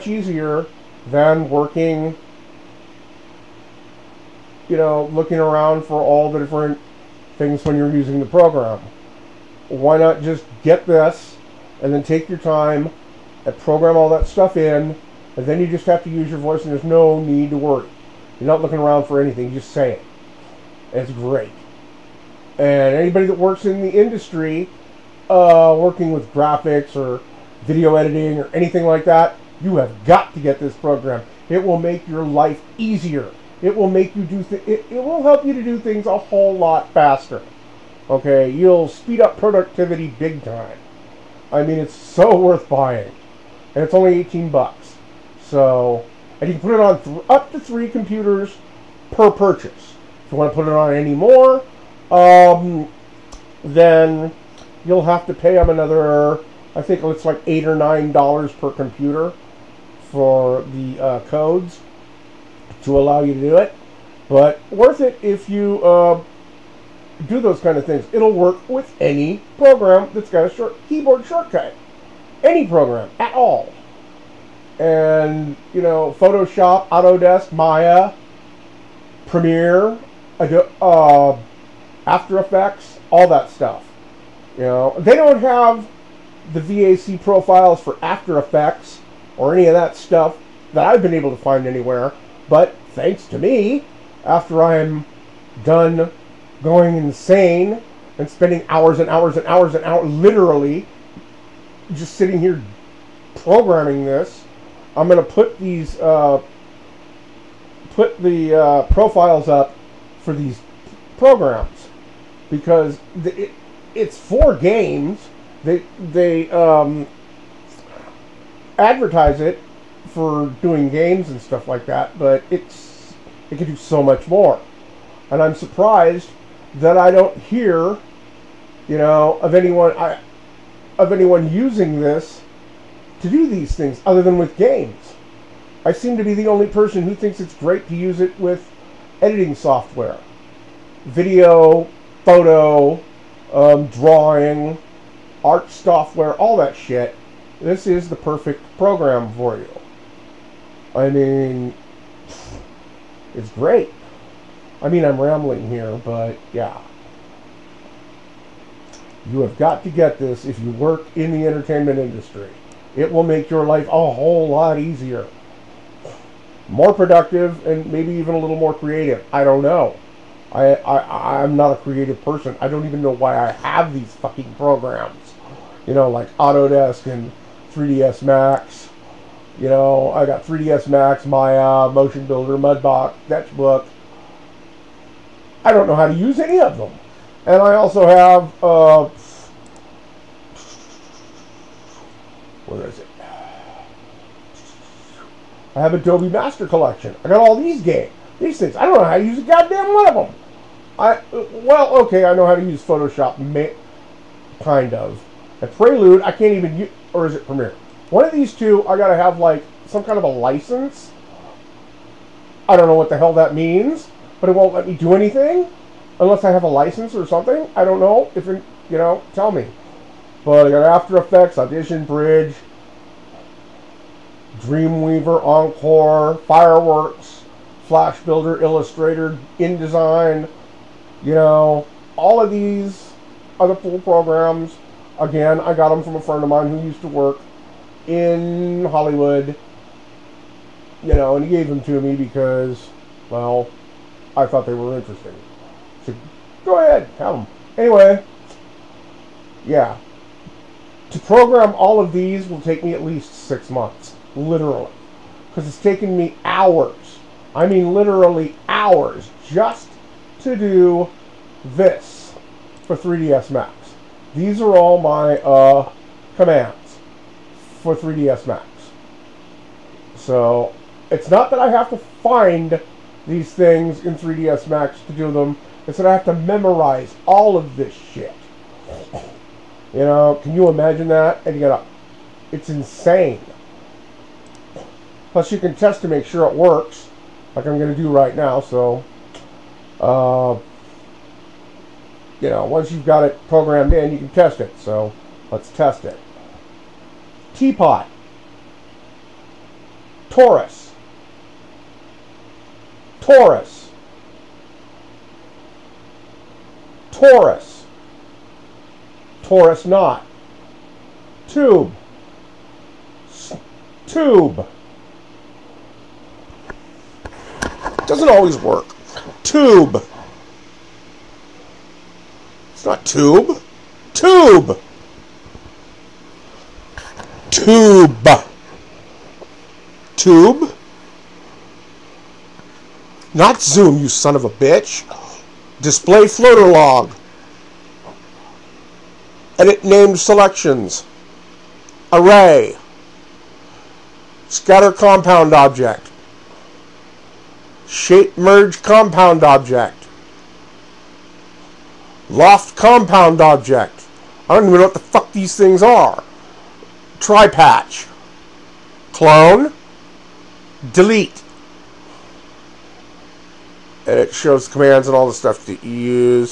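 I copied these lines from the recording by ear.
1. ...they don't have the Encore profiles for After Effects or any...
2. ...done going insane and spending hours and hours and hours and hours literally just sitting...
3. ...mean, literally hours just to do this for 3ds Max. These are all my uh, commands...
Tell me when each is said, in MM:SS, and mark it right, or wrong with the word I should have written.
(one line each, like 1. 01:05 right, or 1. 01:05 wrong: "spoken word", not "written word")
1. 01:24 wrong: "VAC", not "Encore"
2. 01:35 right
3. 04:17 right.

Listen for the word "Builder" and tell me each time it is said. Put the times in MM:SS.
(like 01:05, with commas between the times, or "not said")
03:02, 03:48.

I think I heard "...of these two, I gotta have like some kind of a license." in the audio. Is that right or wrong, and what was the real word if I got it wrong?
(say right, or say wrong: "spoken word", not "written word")
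right.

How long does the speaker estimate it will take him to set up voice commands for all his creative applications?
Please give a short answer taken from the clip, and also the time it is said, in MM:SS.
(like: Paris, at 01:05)
6 months, at 04:13.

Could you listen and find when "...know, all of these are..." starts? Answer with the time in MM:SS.
03:51.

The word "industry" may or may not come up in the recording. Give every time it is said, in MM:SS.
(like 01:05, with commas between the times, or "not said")
00:23, 02:41.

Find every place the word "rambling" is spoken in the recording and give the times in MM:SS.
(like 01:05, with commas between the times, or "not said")
02:35.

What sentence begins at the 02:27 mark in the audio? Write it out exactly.
This is the perfect program for you.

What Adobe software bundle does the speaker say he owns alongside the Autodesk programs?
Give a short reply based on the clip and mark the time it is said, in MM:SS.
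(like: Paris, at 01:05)
Adobe Master Collection, at 03:15.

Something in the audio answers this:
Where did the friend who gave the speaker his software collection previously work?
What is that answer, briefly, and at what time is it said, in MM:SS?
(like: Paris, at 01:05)
Hollywood, at 03:58.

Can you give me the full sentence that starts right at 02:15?
I seem to be the only person who thinks it's great to use it with editing software.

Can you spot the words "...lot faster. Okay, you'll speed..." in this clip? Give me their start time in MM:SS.
00:36.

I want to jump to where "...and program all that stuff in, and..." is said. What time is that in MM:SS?
00:13.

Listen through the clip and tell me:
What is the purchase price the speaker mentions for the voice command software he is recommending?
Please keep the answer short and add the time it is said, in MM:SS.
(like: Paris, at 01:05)
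$18, at 00:44.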